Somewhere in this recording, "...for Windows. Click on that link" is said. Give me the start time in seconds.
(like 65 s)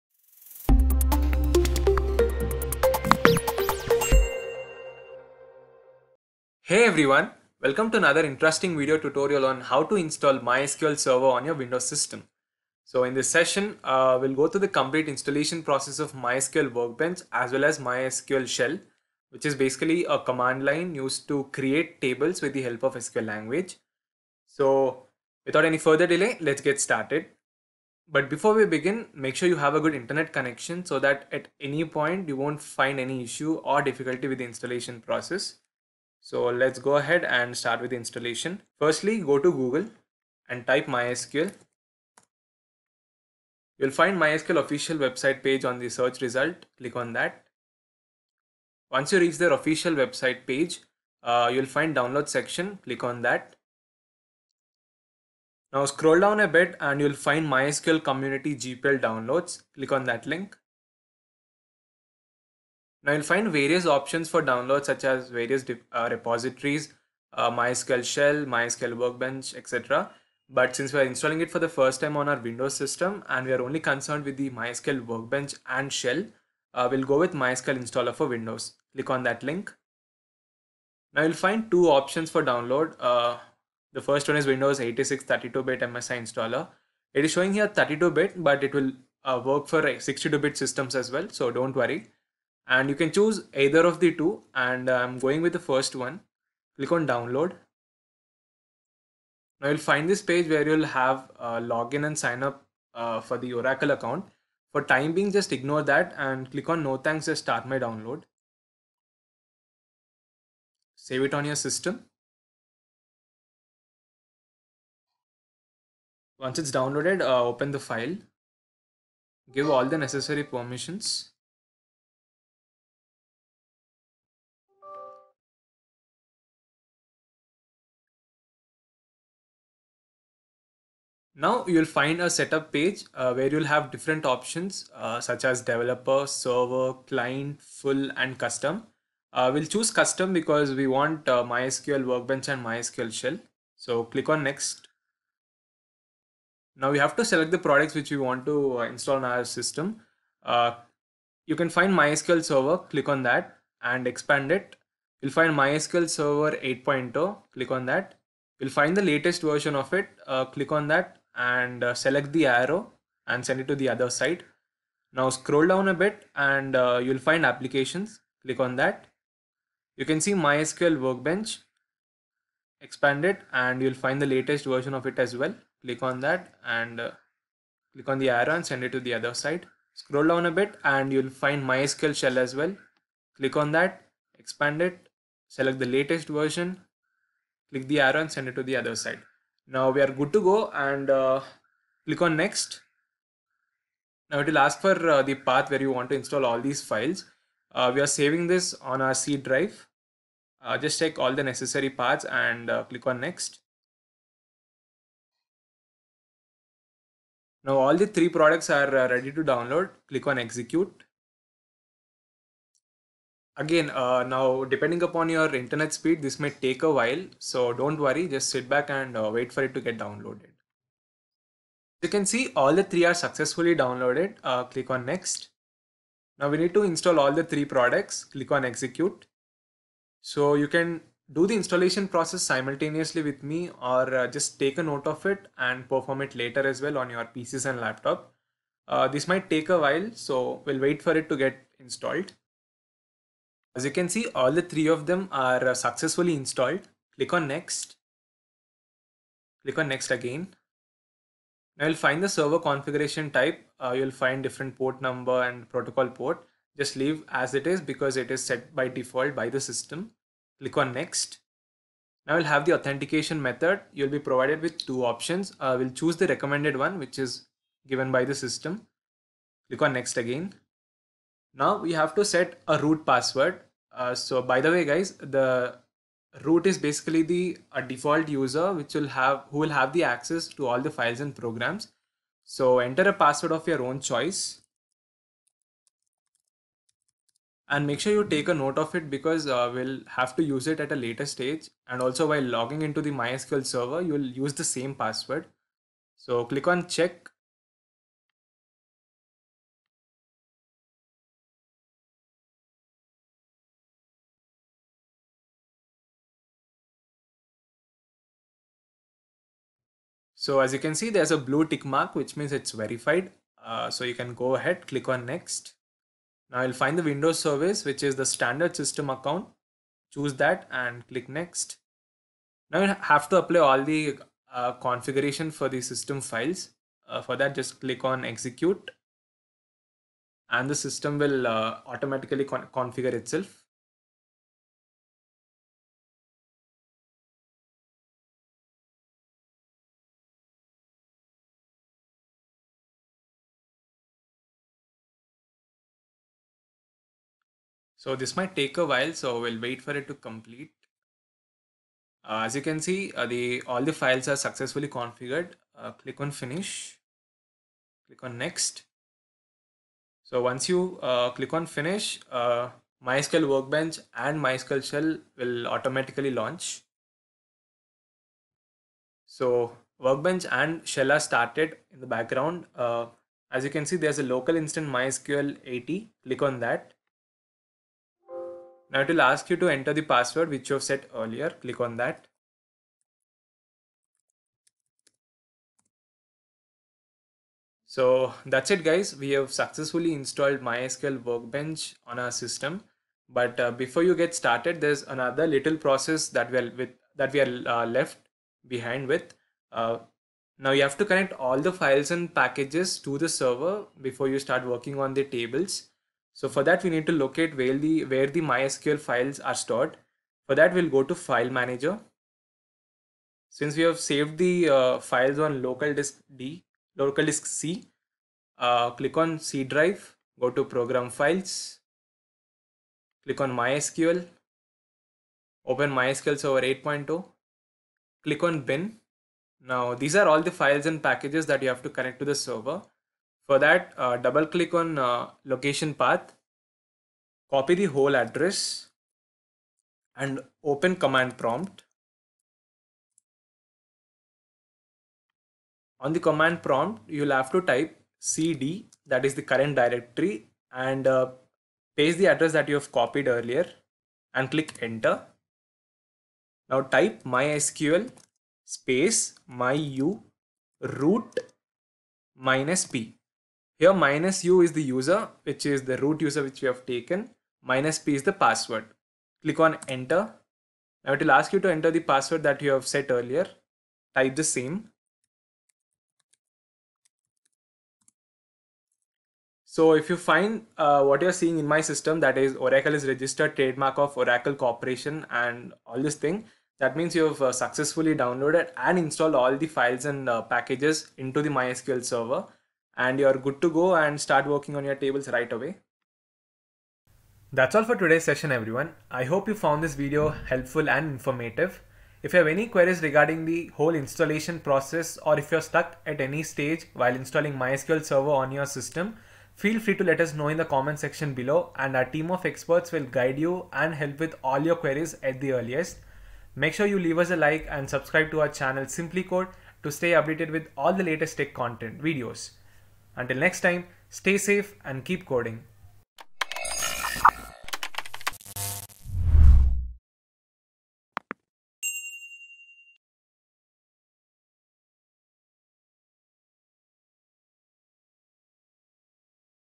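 78 s.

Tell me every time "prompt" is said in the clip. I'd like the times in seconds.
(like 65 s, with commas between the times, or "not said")
441 s, 446 s.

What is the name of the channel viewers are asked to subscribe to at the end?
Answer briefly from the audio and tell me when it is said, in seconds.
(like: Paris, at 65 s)
SimpliCode, at 518 s.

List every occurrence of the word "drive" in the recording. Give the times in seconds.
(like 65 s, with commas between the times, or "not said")
199 s, 419 s.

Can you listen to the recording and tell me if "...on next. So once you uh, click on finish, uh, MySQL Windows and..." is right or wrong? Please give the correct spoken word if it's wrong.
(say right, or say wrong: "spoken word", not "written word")
wrong: "Workbench", not "Windows".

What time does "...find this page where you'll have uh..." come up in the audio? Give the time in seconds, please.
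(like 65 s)
99 s.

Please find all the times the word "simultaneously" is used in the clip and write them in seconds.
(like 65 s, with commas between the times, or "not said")
232 s.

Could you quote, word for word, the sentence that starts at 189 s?
Now we are good to go and uh, click on next.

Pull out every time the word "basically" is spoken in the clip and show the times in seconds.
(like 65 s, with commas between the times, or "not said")
19 s, 276 s.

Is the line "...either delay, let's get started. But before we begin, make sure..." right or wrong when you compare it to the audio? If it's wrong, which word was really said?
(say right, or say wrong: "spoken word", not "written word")
wrong: "further", not "either".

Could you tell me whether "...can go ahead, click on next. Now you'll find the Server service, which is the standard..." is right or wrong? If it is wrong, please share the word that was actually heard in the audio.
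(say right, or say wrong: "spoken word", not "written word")
wrong: "Windows", not "Server".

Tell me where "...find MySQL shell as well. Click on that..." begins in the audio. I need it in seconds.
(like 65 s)
181 s.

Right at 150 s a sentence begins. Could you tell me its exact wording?
Uh, you can find MySQL server, click on that and expand it.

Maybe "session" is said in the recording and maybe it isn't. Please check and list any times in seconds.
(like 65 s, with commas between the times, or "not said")
13 s, 498 s.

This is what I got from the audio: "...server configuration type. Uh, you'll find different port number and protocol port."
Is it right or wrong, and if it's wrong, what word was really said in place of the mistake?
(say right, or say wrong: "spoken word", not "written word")
right.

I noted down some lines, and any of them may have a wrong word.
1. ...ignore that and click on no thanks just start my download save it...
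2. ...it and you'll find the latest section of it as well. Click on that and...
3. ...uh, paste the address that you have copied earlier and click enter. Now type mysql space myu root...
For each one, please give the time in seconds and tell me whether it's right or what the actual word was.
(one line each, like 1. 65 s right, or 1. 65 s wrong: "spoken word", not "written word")
1. 105 s right
2. 173 s wrong: "version", not "section"
3. 451 s right.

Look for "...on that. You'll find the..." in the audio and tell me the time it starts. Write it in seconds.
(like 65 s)
157 s.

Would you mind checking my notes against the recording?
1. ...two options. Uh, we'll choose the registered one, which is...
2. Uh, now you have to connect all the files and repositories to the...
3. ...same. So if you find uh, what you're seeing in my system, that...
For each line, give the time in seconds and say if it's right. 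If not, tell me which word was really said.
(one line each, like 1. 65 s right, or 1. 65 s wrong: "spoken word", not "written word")
1. 264 s wrong: "recommended", not "registered"
2. 399 s wrong: "packages", not "repositories"
3. 474 s right.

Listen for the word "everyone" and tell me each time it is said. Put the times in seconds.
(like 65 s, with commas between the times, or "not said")
6 s, 498 s.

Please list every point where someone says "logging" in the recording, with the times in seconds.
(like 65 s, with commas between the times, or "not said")
292 s.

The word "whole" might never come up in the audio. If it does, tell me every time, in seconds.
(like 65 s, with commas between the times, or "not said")
437 s, 503 s.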